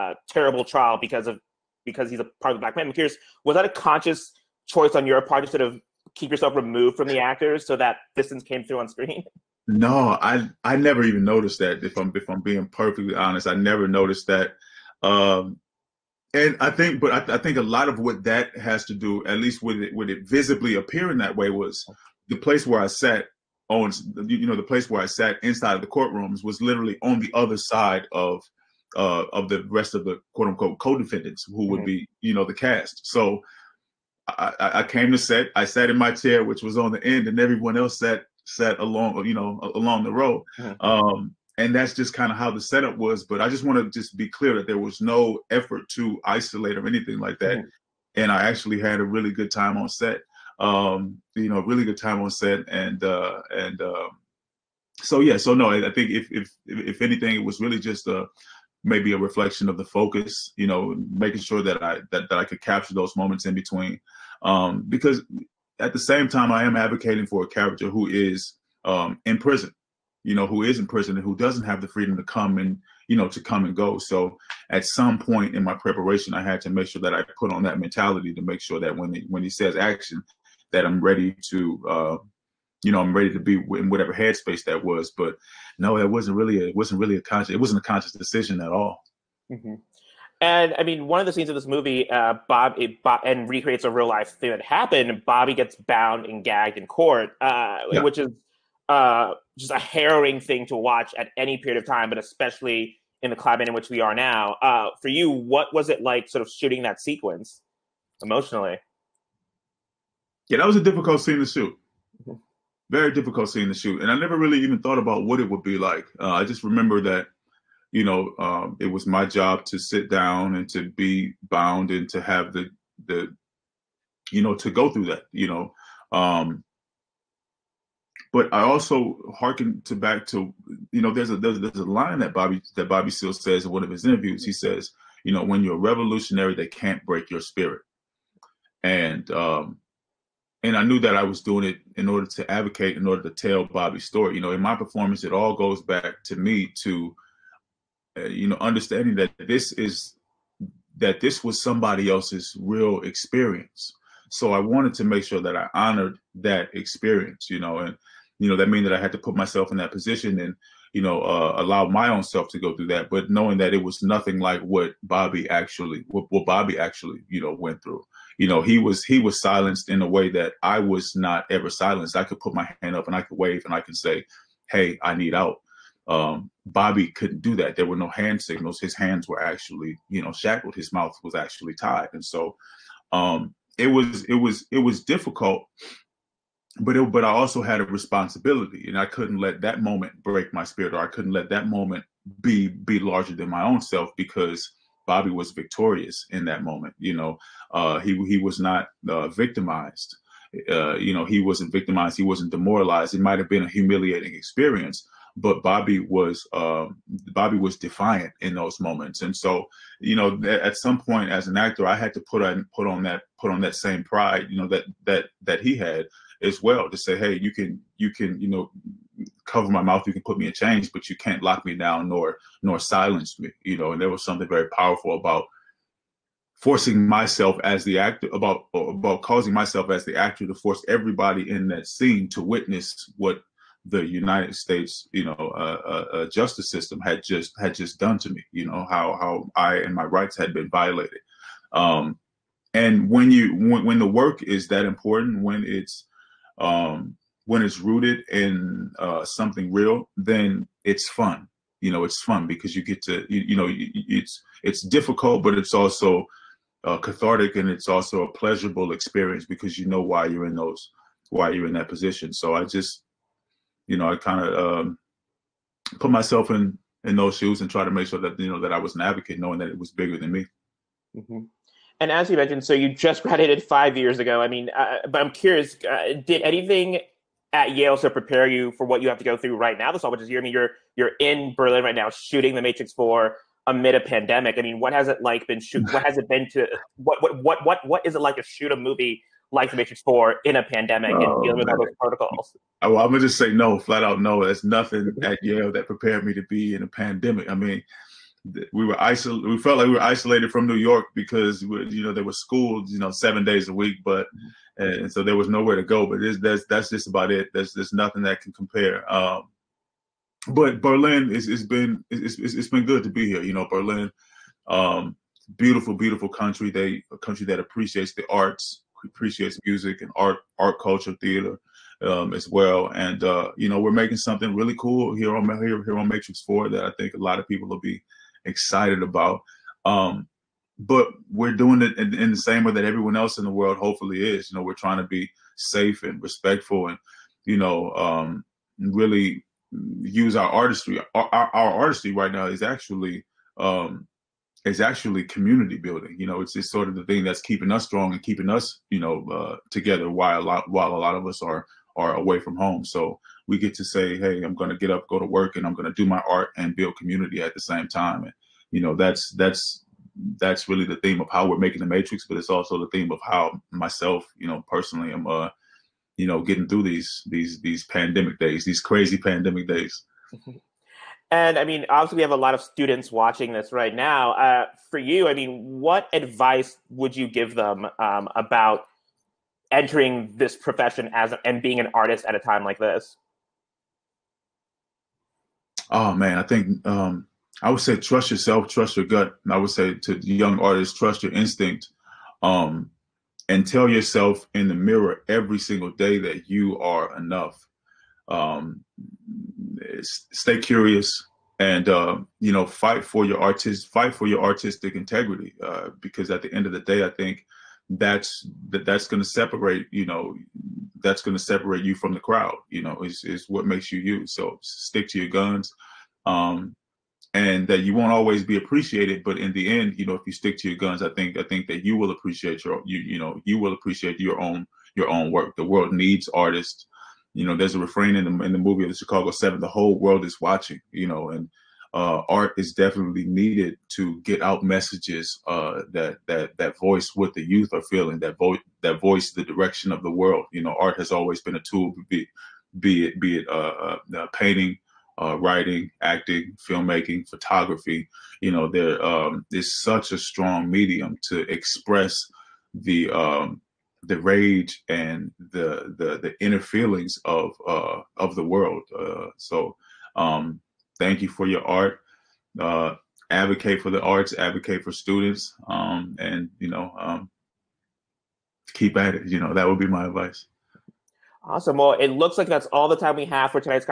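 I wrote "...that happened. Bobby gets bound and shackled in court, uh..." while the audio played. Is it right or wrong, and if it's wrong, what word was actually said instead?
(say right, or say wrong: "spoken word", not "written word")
wrong: "gagged", not "shackled".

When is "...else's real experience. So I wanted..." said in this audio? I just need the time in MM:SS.
02:32.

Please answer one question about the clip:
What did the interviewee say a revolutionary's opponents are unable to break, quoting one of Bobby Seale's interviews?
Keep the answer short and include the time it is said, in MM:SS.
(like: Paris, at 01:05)
Your spirit, at 02:17.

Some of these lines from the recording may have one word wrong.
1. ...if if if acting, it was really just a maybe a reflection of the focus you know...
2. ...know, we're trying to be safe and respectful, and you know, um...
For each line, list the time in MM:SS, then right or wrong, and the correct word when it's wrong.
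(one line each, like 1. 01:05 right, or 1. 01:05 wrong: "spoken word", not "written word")
1. 00:56 wrong: "anything", not "acting"
2. 05:34 right.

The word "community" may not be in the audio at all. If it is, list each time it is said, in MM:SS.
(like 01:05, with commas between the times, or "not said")
05:45, 05:56.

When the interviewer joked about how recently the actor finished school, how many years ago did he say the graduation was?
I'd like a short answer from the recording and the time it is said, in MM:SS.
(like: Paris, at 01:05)
5, at 04:33.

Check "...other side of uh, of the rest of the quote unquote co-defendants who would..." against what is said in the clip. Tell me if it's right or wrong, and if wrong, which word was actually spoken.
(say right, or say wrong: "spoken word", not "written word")
right.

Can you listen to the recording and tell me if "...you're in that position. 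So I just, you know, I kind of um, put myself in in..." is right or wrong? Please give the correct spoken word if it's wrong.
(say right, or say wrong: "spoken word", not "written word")
right.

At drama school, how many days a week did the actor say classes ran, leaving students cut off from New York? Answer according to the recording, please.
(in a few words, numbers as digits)
7.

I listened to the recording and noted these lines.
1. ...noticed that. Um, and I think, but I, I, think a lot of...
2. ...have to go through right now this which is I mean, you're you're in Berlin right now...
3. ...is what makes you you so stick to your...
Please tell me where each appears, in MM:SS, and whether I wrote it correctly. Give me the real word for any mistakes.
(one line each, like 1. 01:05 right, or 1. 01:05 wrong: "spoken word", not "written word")
1. 00:13 right
2. 04:39 right
3. 06:53 right.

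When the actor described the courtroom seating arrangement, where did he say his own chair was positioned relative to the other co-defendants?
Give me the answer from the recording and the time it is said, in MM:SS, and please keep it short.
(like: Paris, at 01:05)
On the end, at 00:36.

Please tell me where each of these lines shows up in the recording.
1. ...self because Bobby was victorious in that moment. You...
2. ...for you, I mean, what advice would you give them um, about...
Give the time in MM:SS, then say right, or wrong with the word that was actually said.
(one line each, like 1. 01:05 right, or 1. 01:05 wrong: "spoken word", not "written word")
1. 03:13 right
2. 06:14 right.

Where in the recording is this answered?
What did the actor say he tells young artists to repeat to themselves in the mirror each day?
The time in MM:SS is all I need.
06:36.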